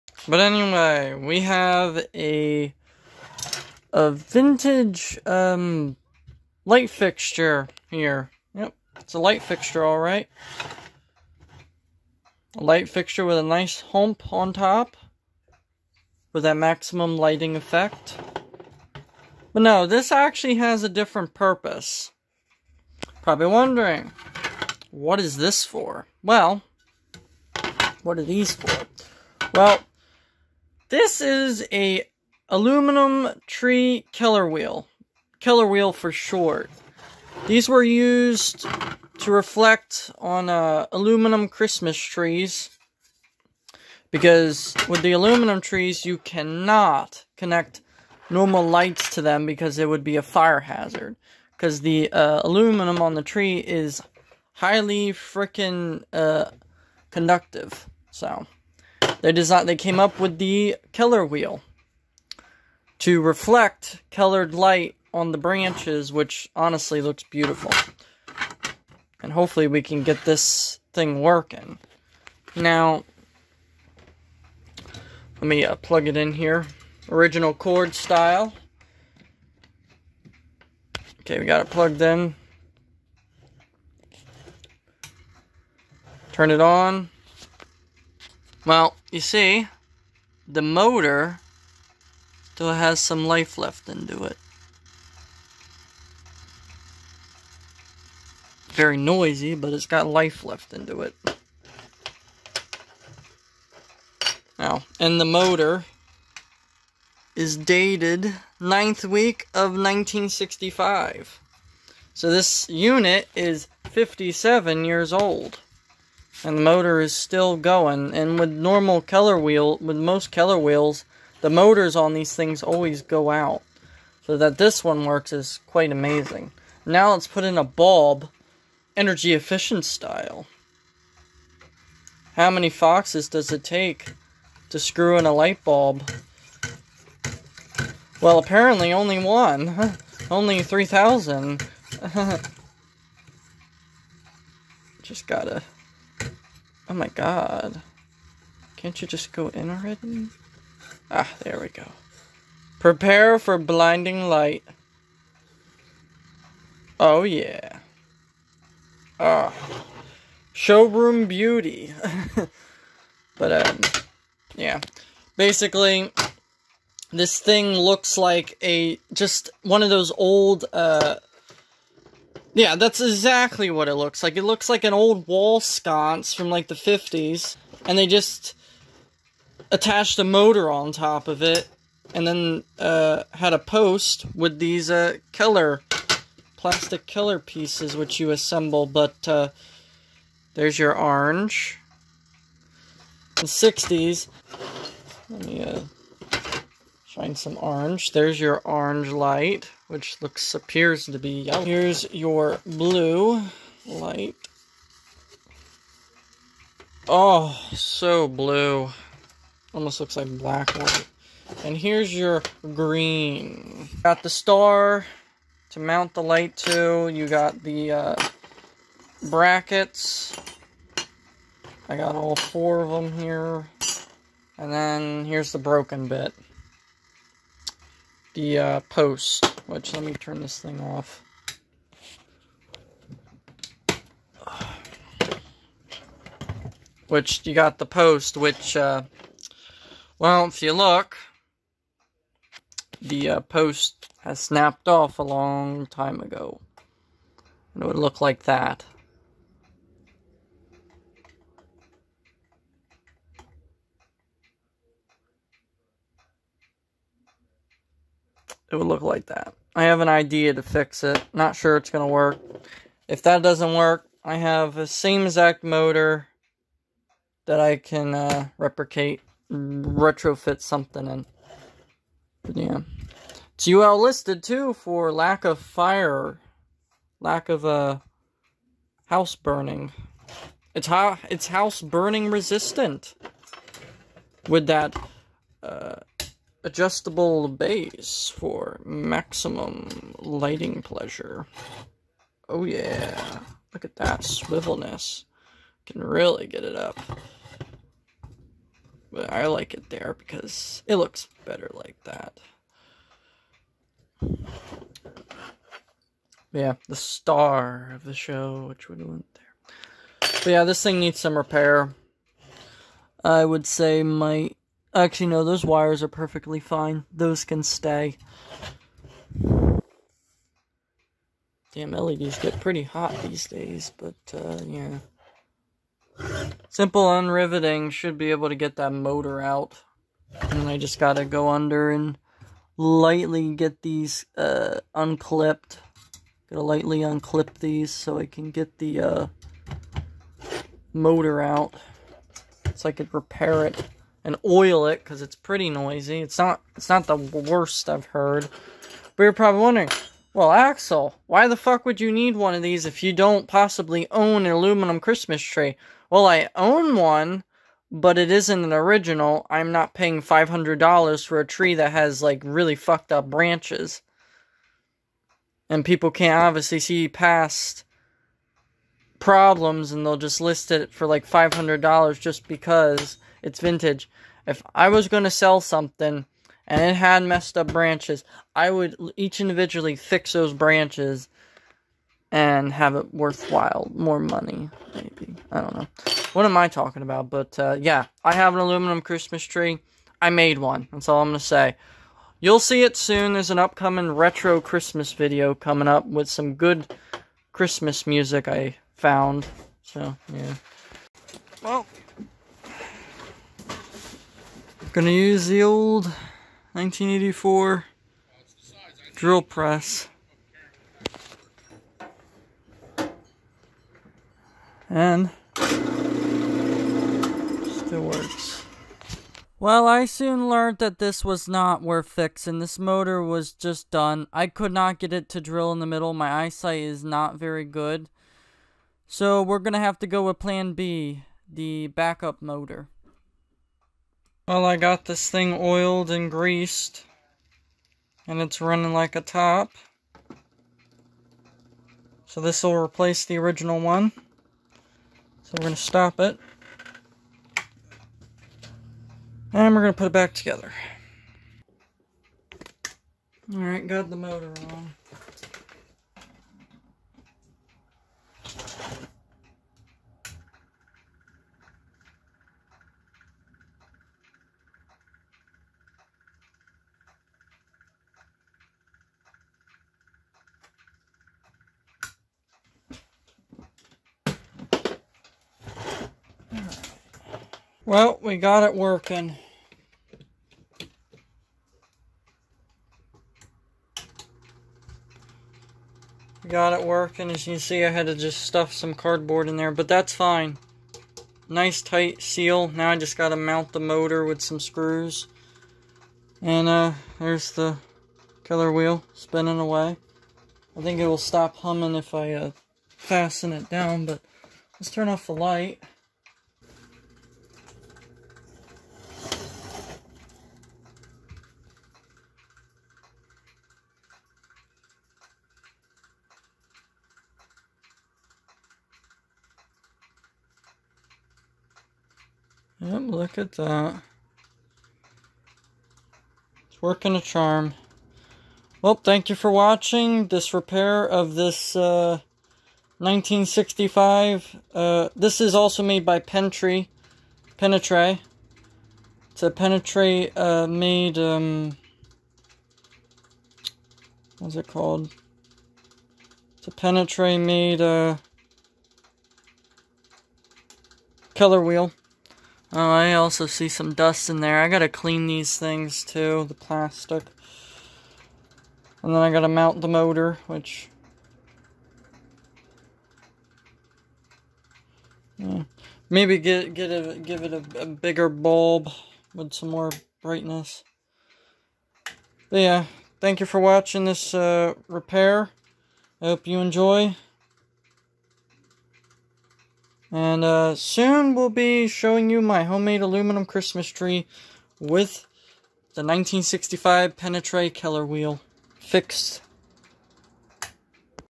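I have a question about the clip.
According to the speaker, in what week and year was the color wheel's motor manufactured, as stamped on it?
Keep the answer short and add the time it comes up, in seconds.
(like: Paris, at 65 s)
9th week of 1965, at 108 s.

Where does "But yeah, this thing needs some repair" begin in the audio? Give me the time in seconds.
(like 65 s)
310 s.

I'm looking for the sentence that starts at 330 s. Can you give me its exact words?
And I just gotta go under and lightly get these, uh, unclipped.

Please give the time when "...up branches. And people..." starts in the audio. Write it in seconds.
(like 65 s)
363 s.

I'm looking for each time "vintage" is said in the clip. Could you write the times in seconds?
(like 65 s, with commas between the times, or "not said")
4 s, 373 s.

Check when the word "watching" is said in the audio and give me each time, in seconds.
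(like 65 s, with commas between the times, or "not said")
529 s, 573 s.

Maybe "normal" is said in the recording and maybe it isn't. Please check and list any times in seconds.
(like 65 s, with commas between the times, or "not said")
48 s, 118 s.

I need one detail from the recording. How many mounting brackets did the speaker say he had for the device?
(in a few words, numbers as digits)
4.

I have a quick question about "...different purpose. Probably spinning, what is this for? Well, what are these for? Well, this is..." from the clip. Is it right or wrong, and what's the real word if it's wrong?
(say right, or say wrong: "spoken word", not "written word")
wrong: "wondering", not "spinning".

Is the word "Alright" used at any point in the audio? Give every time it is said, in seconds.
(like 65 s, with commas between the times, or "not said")
453 s.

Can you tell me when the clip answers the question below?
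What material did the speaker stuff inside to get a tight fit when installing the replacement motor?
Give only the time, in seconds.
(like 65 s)
488 s.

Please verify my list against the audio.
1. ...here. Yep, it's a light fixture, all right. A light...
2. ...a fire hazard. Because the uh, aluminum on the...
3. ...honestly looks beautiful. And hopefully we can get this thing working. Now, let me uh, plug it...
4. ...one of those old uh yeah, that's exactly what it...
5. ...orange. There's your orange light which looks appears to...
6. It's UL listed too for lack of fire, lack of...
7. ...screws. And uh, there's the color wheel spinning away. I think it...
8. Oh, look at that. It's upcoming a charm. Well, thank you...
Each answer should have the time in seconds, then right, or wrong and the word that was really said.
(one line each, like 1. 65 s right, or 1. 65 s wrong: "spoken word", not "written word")
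1. 7 s right
2. 50 s right
3. 66 s right
4. 169 s right
5. 197 s right
6. 273 s right
7. 494 s right
8. 522 s wrong: "working", not "upcoming".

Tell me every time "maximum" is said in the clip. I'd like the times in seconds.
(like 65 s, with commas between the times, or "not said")
16 s, 288 s.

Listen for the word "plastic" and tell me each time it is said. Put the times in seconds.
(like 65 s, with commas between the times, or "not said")
186 s, 556 s.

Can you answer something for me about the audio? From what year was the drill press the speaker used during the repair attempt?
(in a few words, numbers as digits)
1984.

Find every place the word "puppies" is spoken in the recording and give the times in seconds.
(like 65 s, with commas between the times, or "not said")
not said.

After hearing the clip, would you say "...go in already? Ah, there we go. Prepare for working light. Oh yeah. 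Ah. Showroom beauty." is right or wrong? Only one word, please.
wrong.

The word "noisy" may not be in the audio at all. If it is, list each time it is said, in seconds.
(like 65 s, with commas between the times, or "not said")
98 s, 345 s.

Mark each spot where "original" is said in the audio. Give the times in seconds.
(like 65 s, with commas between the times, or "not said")
77 s, 358 s, 443 s.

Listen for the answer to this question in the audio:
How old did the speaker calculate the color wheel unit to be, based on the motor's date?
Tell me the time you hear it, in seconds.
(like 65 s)
113 s.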